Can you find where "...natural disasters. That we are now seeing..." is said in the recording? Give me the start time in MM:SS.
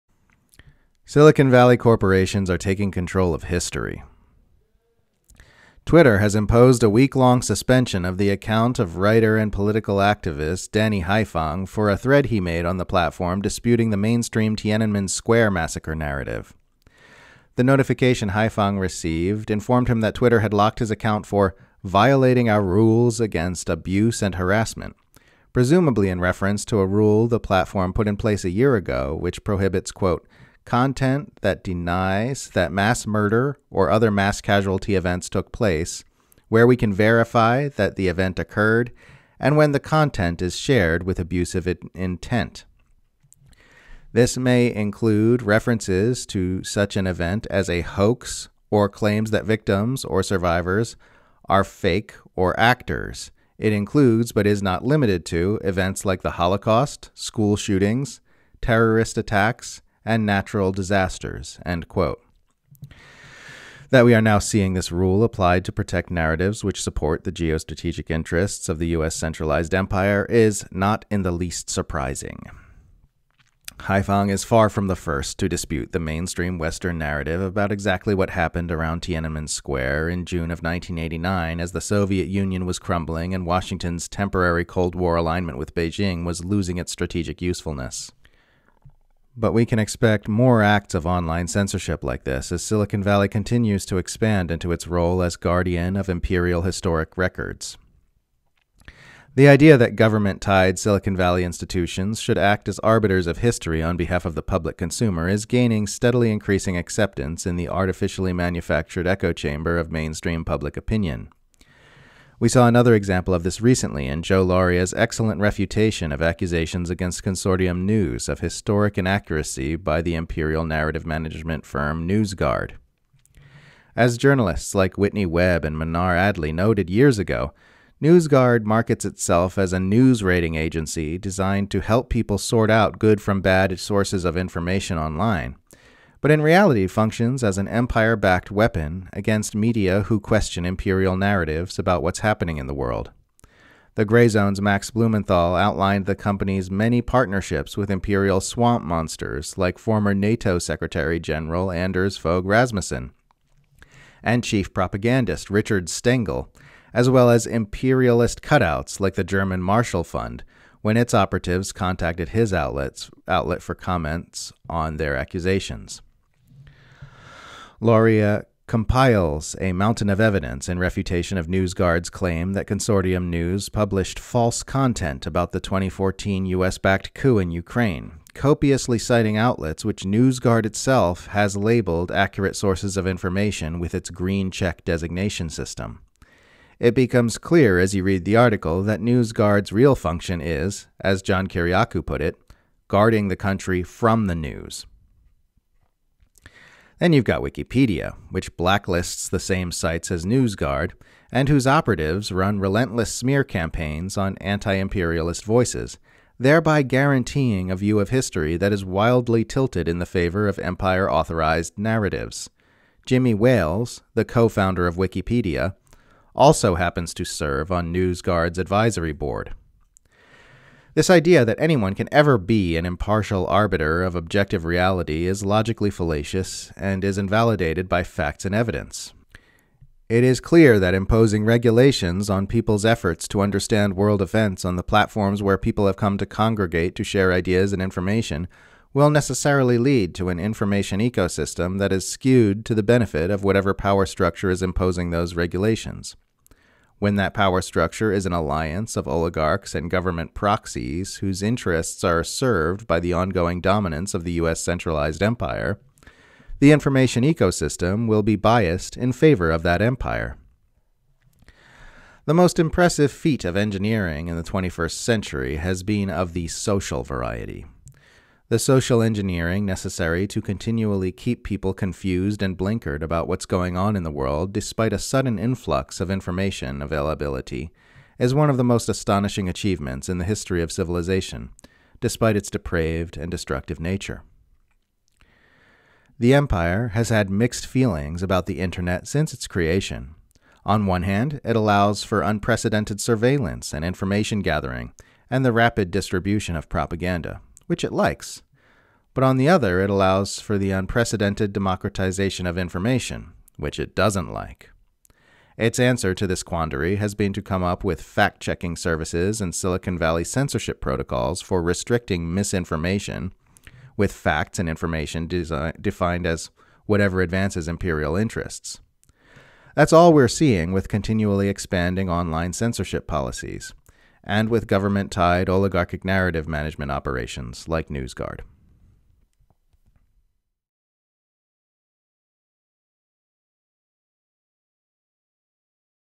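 01:00.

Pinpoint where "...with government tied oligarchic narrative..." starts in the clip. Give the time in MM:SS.
05:24.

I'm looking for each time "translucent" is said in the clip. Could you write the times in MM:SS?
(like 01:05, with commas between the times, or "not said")
not said.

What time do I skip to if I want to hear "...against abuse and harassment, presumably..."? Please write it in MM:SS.
00:23.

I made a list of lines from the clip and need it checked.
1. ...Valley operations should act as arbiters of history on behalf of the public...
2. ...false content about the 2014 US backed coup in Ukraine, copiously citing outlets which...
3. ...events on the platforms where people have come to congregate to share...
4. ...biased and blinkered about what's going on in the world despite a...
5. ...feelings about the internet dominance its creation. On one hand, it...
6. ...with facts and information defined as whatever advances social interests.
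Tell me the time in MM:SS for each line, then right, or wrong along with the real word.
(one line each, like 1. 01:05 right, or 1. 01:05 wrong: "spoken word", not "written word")
1. 01:41 wrong: "institutions", not "operations"
2. 02:54 right
3. 03:54 right
4. 04:31 wrong: "confused", not "biased"
5. 04:47 wrong: "since", not "dominance"
6. 05:13 wrong: "imperial", not "social".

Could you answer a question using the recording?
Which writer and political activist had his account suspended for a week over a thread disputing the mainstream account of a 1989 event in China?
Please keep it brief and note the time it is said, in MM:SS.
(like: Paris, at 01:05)
Danny Haiphong, at 00:10.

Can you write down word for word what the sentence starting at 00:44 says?
This may include references to such an event as a hoax or claims that victims or survivors are fake or actors.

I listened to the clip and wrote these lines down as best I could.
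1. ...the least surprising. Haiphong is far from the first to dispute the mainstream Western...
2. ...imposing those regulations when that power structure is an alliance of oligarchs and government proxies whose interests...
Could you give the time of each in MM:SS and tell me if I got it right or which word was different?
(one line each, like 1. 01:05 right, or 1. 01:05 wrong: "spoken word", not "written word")
1. 01:11 right
2. 04:04 right.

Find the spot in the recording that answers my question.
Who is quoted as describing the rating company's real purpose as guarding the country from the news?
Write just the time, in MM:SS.
03:11.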